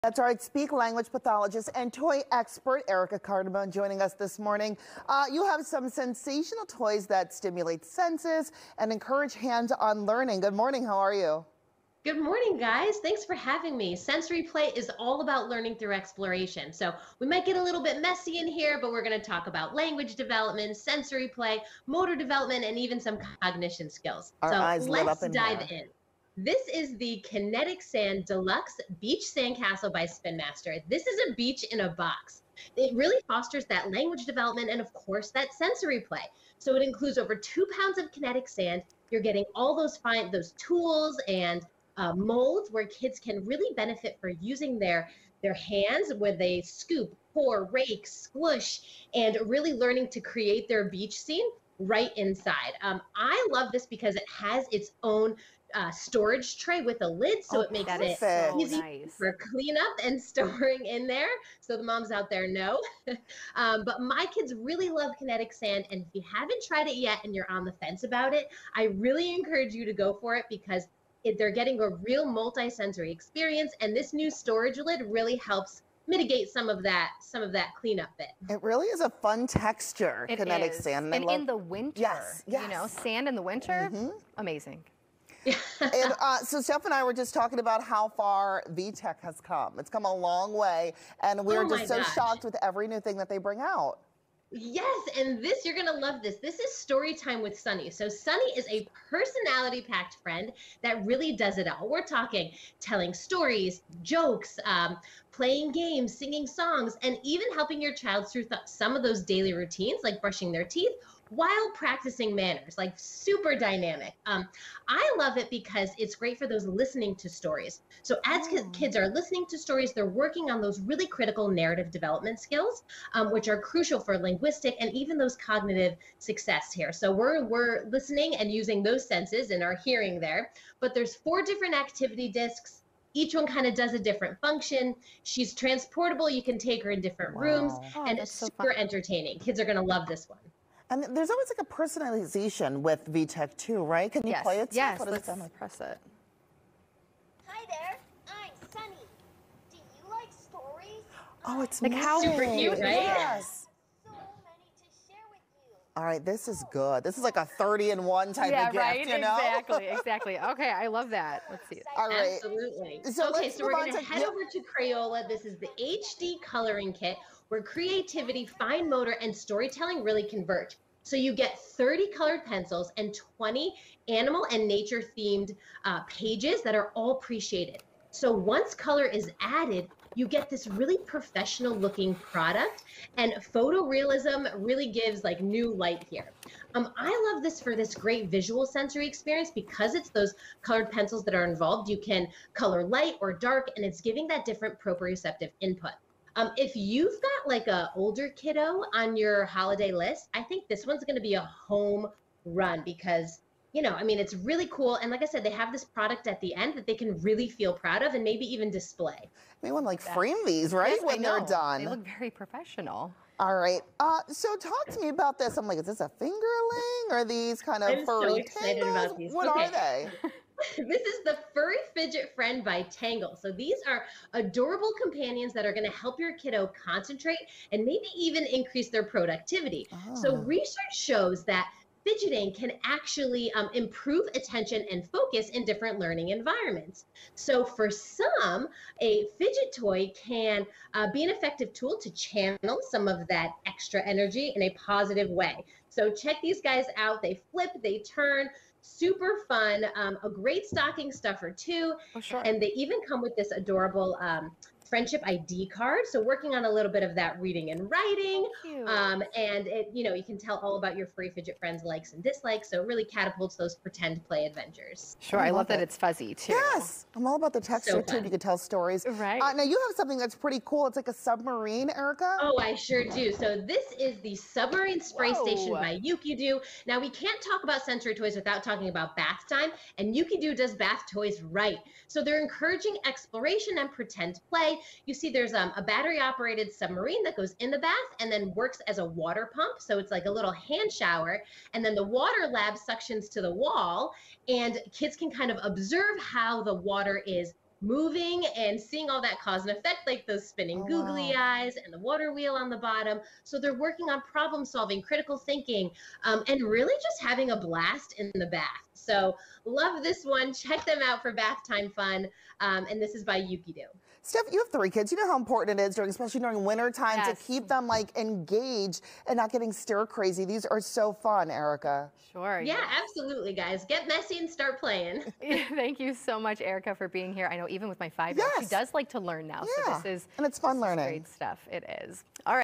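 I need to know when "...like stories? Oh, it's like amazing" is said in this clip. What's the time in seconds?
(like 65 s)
150 s.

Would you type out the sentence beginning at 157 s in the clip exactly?
This is like a 30 and 1 type yeah, of gift, right?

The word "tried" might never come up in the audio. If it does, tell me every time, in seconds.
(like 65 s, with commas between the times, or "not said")
66 s.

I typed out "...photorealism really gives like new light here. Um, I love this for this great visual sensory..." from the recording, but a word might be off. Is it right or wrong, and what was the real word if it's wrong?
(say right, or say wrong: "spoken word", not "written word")
right.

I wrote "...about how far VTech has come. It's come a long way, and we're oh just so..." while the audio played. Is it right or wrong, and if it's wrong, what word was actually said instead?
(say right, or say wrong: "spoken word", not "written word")
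right.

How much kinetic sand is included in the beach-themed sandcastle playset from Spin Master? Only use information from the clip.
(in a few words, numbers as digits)
Over 2 pounds.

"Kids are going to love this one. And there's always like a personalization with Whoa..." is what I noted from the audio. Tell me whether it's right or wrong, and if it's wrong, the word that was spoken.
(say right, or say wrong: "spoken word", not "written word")
wrong: "VTech", not "Whoa".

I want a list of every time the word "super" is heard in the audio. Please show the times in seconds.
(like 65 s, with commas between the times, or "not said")
112 s, 138 s, 152 s, 248 s.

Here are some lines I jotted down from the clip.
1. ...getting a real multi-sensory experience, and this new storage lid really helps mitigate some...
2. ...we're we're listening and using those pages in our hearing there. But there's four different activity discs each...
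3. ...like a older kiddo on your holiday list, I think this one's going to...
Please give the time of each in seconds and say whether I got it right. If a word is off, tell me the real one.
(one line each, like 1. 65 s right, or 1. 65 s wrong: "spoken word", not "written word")
1. 71 s right
2. 127 s wrong: "senses", not "pages"
3. 197 s right.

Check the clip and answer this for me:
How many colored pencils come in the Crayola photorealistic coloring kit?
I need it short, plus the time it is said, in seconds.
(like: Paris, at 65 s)
30, at 171 s.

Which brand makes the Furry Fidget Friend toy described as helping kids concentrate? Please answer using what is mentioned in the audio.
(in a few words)
Tangle.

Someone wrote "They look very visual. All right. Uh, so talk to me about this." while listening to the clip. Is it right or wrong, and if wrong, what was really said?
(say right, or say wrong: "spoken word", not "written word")
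wrong: "professional", not "visual".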